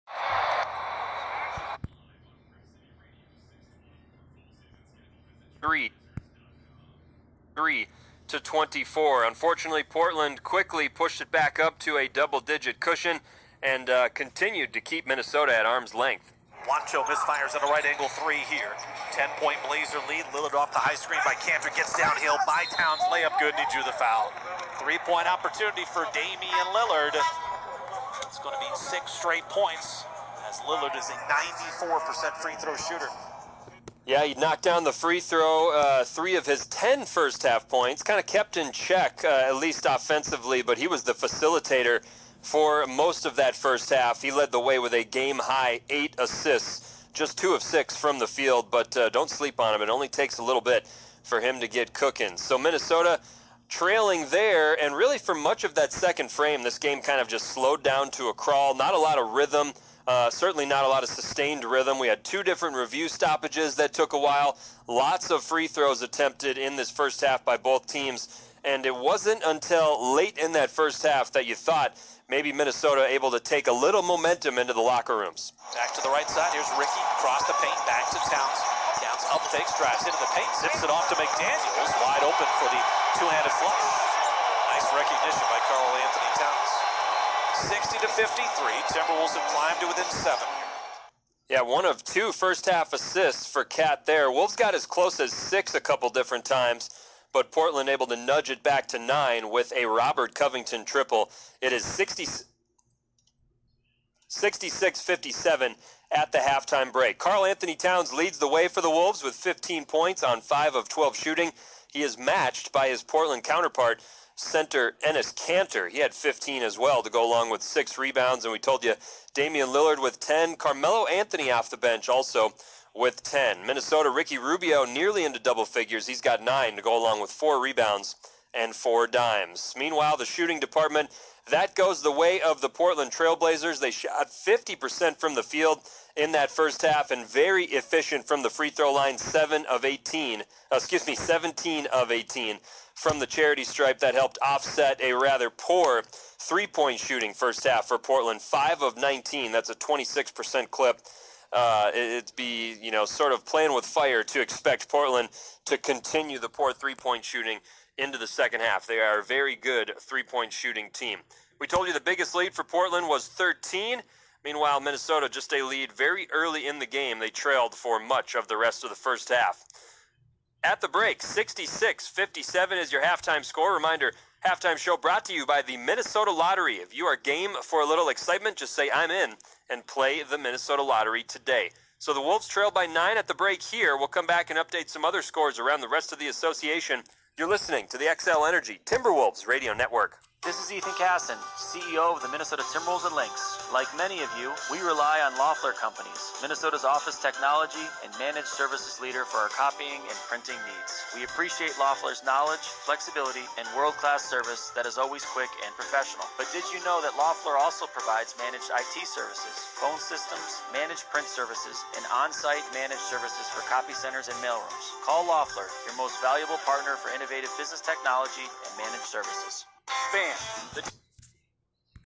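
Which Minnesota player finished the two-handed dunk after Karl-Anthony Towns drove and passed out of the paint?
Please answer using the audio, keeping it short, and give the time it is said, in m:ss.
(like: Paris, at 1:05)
McDaniels, at 1:21.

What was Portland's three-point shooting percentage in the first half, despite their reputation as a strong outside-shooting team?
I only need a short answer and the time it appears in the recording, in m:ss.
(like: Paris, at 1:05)
26%, at 2:29.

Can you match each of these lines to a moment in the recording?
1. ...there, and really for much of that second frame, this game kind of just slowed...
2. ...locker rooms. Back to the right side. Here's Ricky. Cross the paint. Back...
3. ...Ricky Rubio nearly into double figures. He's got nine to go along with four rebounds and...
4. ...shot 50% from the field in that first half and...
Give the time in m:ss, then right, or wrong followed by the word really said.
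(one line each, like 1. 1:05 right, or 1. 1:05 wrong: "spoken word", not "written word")
1. 0:54 right
2. 1:14 right
3. 2:04 right
4. 2:13 right.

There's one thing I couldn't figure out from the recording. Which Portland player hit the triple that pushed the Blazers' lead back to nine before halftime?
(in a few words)
Robert Covington.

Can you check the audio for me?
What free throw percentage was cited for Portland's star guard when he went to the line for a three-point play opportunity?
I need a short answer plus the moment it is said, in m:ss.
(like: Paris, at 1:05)
94%, at 0:31.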